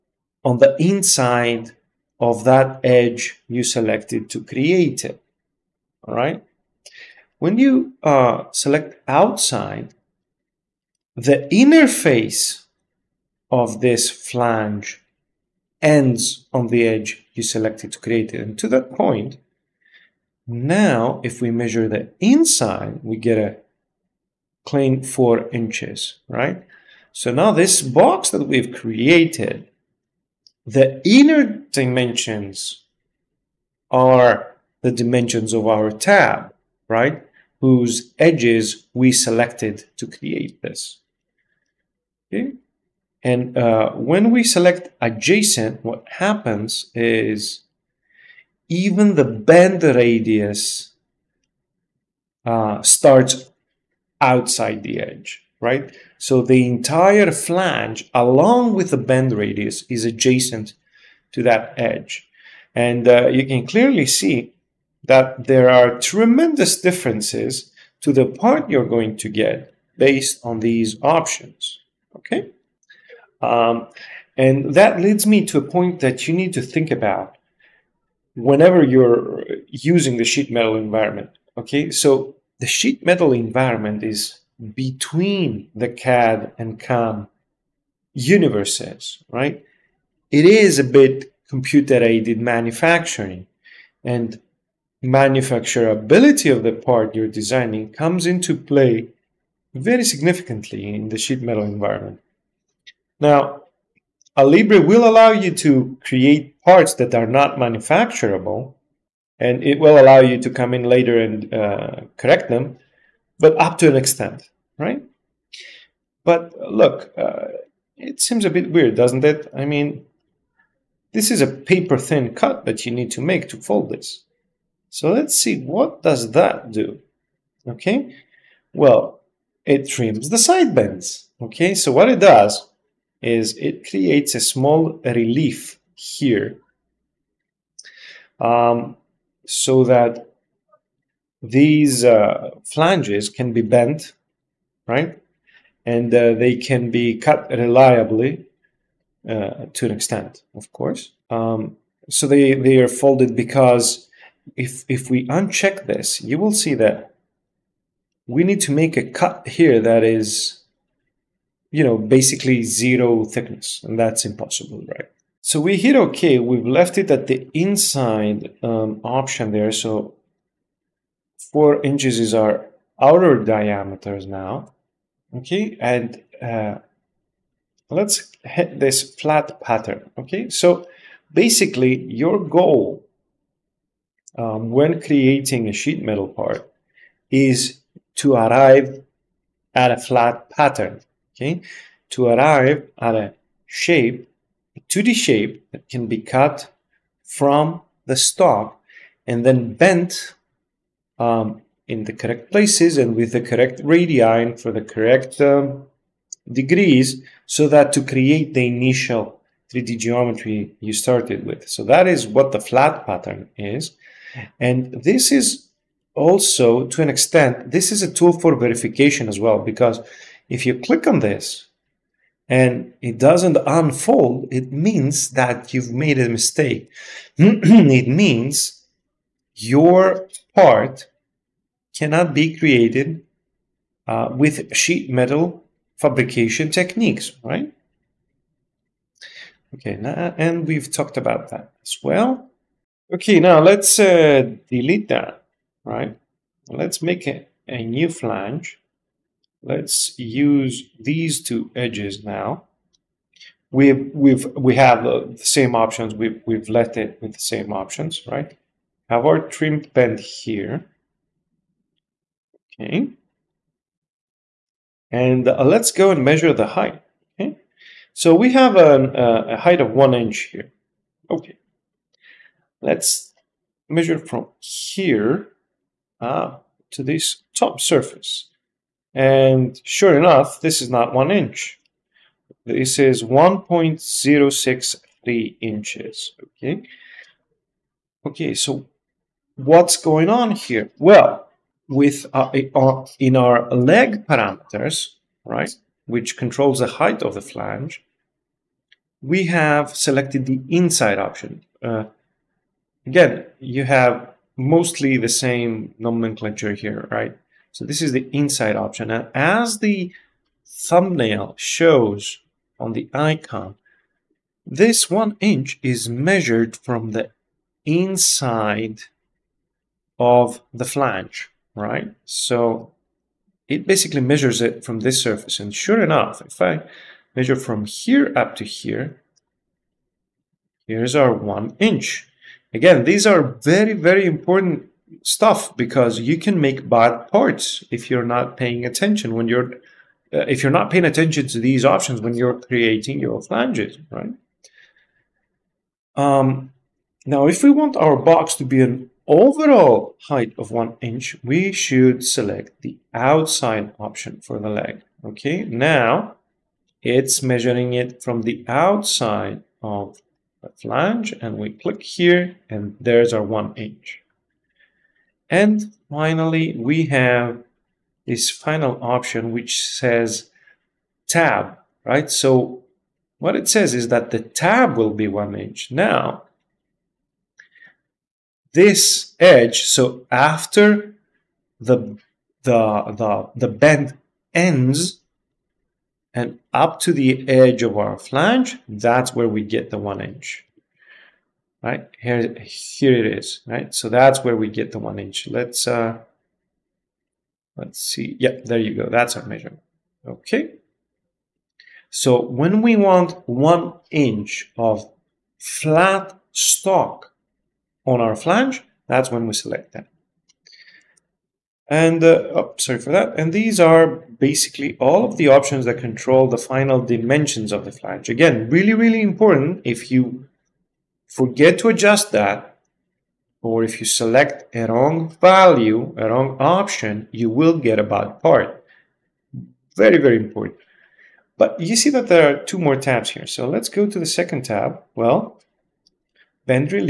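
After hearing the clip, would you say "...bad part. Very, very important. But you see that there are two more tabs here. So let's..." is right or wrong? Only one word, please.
right.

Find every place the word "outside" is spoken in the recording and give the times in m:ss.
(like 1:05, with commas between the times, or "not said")
0:09, 0:54, 5:53, 5:58.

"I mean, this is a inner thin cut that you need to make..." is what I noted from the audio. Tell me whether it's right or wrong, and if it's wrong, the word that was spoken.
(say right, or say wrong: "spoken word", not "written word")
wrong: "paper", not "inner".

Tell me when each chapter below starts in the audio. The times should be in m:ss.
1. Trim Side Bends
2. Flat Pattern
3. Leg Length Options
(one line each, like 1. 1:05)
1. 2:00
2. 2:54
3. 4:04.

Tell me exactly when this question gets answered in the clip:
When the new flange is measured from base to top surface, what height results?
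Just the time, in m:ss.
4:43.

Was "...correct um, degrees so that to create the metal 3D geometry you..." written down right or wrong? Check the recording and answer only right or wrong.
wrong.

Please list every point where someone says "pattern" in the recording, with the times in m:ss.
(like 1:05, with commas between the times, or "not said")
2:59, 3:10, 3:33.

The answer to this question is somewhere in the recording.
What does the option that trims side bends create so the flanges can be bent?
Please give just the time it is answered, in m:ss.
2:14.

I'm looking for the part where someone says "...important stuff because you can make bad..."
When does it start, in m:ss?
5:34.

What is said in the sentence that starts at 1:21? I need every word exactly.
Okay, so the sheet metal environment is between the CAD and CAM universes, right?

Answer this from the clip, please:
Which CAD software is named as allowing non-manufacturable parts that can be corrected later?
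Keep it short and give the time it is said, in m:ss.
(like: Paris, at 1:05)
Alibre, at 1:44.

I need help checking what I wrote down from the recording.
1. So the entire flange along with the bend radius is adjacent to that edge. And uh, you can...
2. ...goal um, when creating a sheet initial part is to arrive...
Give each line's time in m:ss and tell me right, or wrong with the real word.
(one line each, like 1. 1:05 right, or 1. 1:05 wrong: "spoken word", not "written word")
1. 0:56 right
2. 3:02 wrong: "metal", not "initial".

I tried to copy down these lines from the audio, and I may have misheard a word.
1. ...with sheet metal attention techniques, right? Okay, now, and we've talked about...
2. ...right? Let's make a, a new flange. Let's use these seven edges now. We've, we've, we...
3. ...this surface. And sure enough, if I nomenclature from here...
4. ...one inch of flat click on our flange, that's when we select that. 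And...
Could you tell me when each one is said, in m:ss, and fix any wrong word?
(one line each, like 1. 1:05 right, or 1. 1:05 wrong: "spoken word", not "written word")
1. 3:54 wrong: "fabrication", not "attention"
2. 4:05 wrong: "two", not "seven"
3. 5:25 wrong: "measure", not "nomenclature"
4. 6:43 wrong: "stock", not "click".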